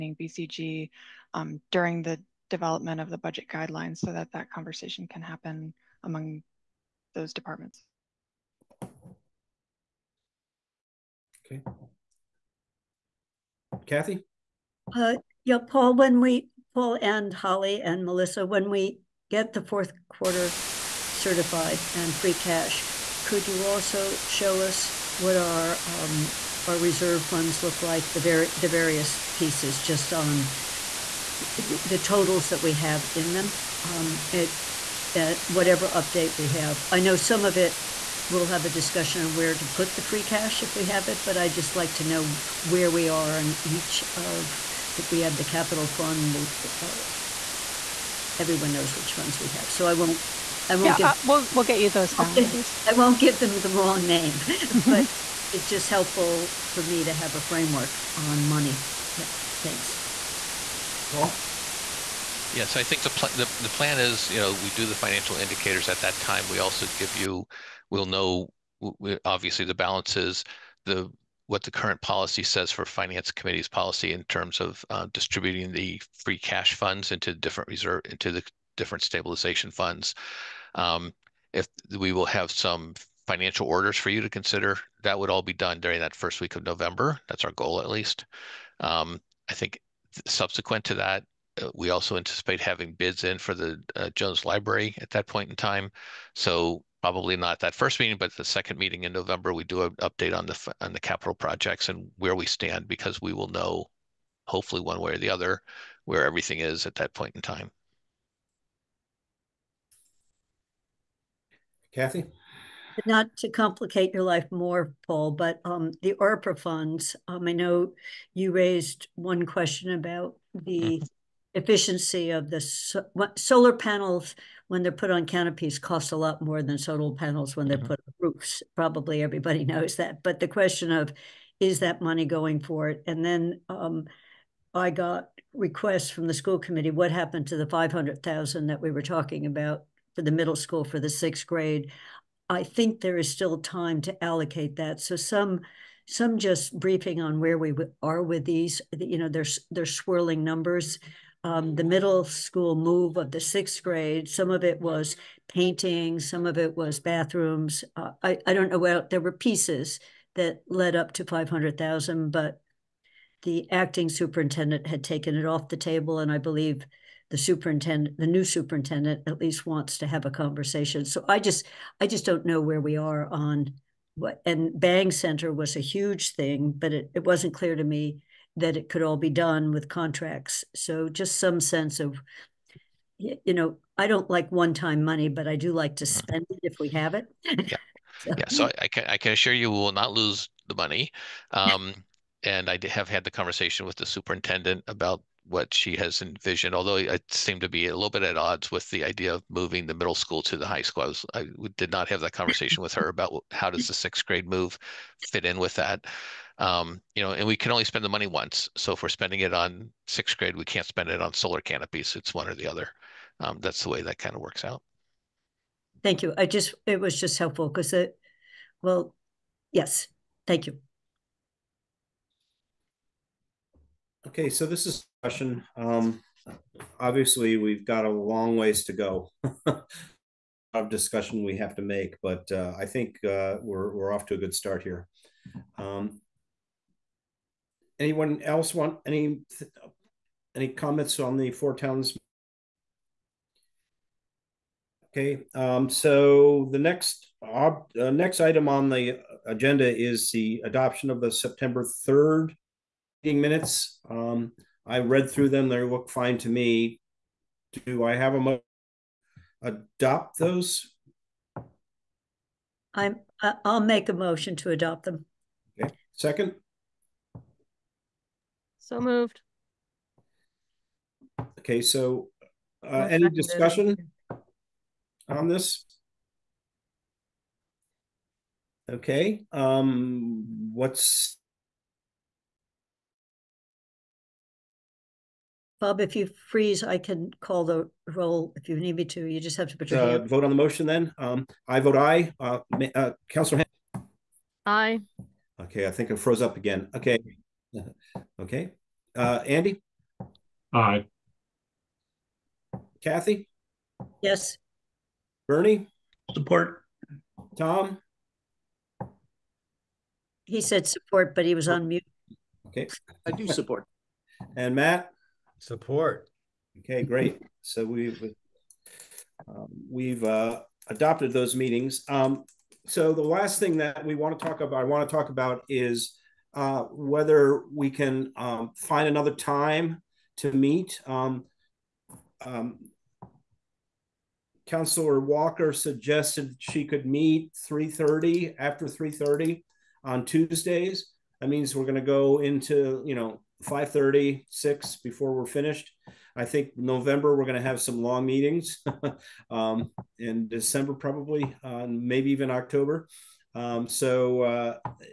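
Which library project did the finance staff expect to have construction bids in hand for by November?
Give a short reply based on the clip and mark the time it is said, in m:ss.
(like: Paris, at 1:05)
Jones Library, at 1:34.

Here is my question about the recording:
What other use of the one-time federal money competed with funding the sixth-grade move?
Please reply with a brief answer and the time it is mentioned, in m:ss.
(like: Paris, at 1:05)
solar canopies, at 3:31.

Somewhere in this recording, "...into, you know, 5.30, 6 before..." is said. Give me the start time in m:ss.
5:42.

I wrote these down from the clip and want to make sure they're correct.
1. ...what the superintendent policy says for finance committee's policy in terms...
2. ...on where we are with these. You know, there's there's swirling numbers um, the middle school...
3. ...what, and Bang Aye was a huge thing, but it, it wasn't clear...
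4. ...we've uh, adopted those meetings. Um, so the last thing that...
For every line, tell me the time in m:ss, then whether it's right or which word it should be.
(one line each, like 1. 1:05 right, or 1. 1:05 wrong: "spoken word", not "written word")
1. 1:11 wrong: "current", not "superintendent"
2. 2:27 right
3. 2:54 wrong: "Center", not "Aye"
4. 5:19 right.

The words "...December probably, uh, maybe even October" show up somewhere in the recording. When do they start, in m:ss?
5:50.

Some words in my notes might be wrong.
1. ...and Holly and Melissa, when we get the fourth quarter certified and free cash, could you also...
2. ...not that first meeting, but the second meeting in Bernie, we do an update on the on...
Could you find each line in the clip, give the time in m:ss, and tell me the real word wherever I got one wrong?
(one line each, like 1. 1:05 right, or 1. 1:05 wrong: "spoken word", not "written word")
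1. 0:17 right
2. 1:37 wrong: "November", not "Bernie".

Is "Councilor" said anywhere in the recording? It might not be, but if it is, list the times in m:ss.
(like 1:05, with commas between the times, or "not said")
4:53, 5:34.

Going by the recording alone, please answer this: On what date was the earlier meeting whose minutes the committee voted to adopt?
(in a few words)
September 3.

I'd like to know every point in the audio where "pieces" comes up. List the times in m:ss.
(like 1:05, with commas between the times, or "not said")
0:29, 2:39.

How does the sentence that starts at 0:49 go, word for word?
So I won't I won't yeah, give, uh, we'll we'll get you those balances.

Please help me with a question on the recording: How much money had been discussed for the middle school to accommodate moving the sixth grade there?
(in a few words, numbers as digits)
$500,000.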